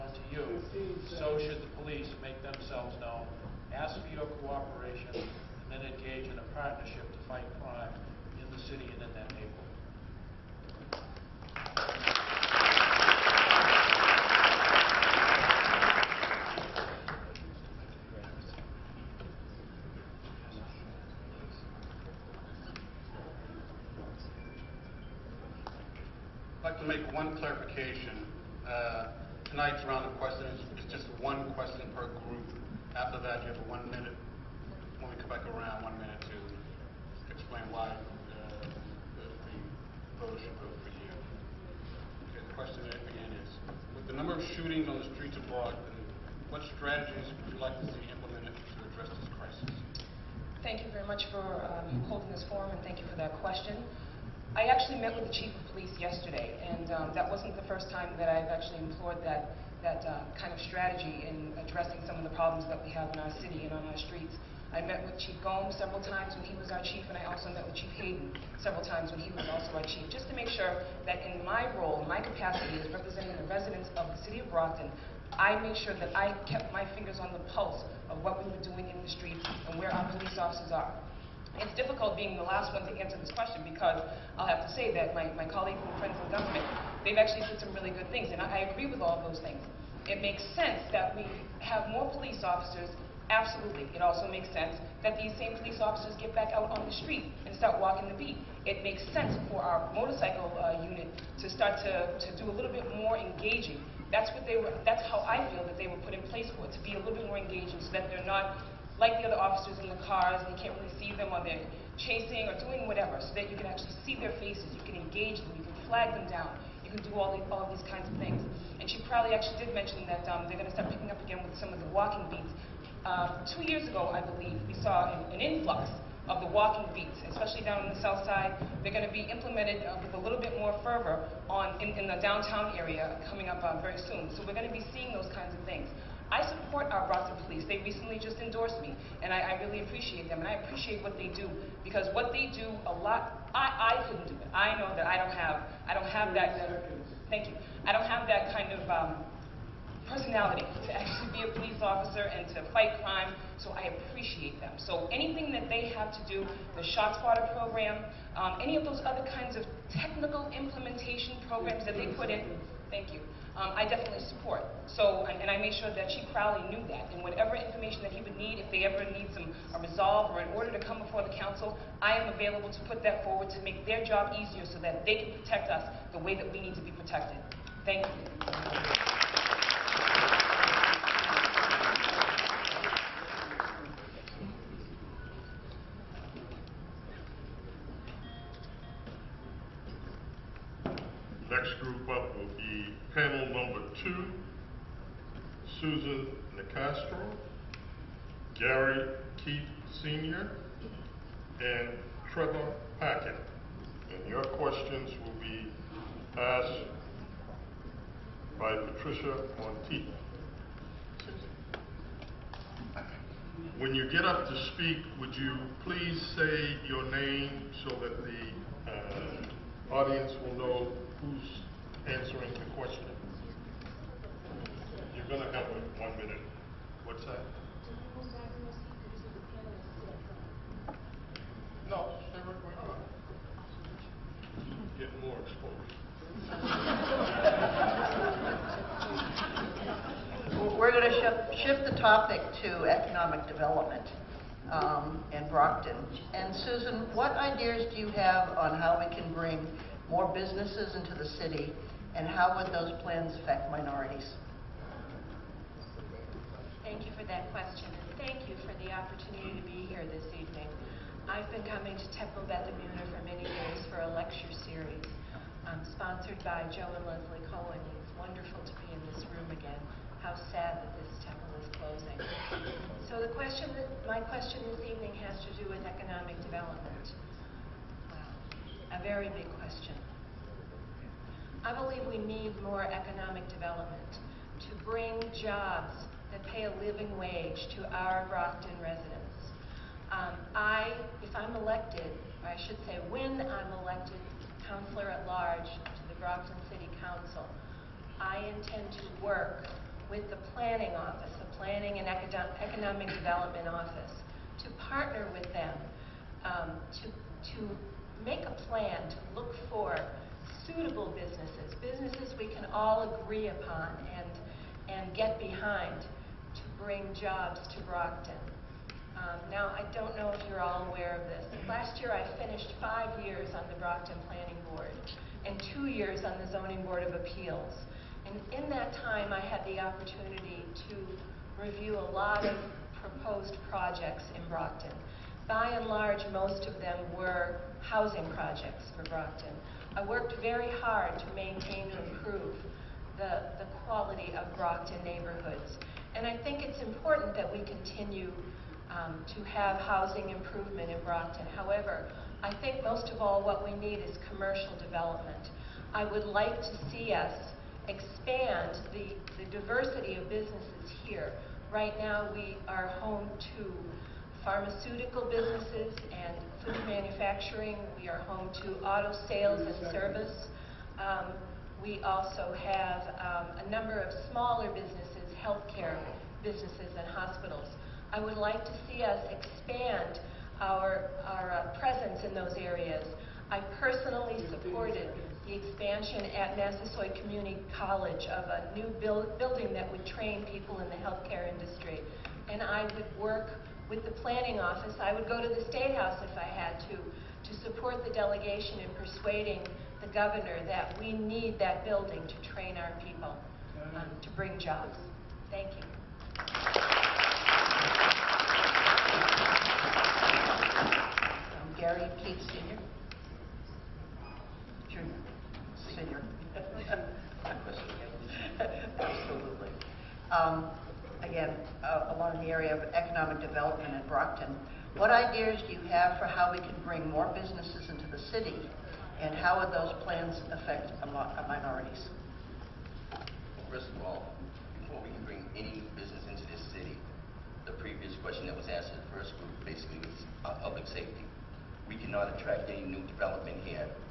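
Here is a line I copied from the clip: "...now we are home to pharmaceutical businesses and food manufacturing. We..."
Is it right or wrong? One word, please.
right.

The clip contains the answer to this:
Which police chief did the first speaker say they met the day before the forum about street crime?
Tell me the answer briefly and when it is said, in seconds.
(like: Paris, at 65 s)
Chief Crowley, at 166 s.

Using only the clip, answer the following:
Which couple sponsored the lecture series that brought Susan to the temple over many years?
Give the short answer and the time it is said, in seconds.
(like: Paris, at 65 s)
Joe and Leslie Cohen, at 266 s.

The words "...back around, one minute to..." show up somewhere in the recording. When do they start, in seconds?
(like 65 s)
35 s.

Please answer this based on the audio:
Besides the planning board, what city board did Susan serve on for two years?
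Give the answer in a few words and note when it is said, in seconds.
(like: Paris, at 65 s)
Zoning Board of Appeals, at 326 s.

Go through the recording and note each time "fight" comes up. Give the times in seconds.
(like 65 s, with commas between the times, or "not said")
7 s, 152 s.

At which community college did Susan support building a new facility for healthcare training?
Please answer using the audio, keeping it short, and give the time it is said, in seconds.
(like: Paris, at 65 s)
Massasoit Community College, at 386 s.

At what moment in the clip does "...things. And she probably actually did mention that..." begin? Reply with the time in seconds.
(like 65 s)
118 s.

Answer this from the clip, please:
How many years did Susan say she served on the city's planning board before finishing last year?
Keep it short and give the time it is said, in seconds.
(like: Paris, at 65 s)
5, at 322 s.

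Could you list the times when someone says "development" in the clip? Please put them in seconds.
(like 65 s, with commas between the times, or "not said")
243 s, 276 s, 283 s, 303 s, 354 s, 423 s, 443 s.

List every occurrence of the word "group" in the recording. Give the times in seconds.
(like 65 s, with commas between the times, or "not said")
32 s, 191 s, 439 s.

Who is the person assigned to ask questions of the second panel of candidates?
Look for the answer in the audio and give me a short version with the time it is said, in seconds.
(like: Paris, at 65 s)
Patricia Monteith, at 208 s.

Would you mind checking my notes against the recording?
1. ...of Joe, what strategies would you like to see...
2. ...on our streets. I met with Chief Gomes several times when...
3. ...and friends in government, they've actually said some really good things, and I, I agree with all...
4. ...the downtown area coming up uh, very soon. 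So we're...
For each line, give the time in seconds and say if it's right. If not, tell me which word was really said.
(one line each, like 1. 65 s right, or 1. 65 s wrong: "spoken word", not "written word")
1. 45 s wrong: "Boston", not "Joe"
2. 63 s right
3. 85 s right
4. 132 s right.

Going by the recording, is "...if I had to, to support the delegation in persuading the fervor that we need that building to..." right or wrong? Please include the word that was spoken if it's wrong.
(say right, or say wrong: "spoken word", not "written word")
wrong: "governor", not "fervor".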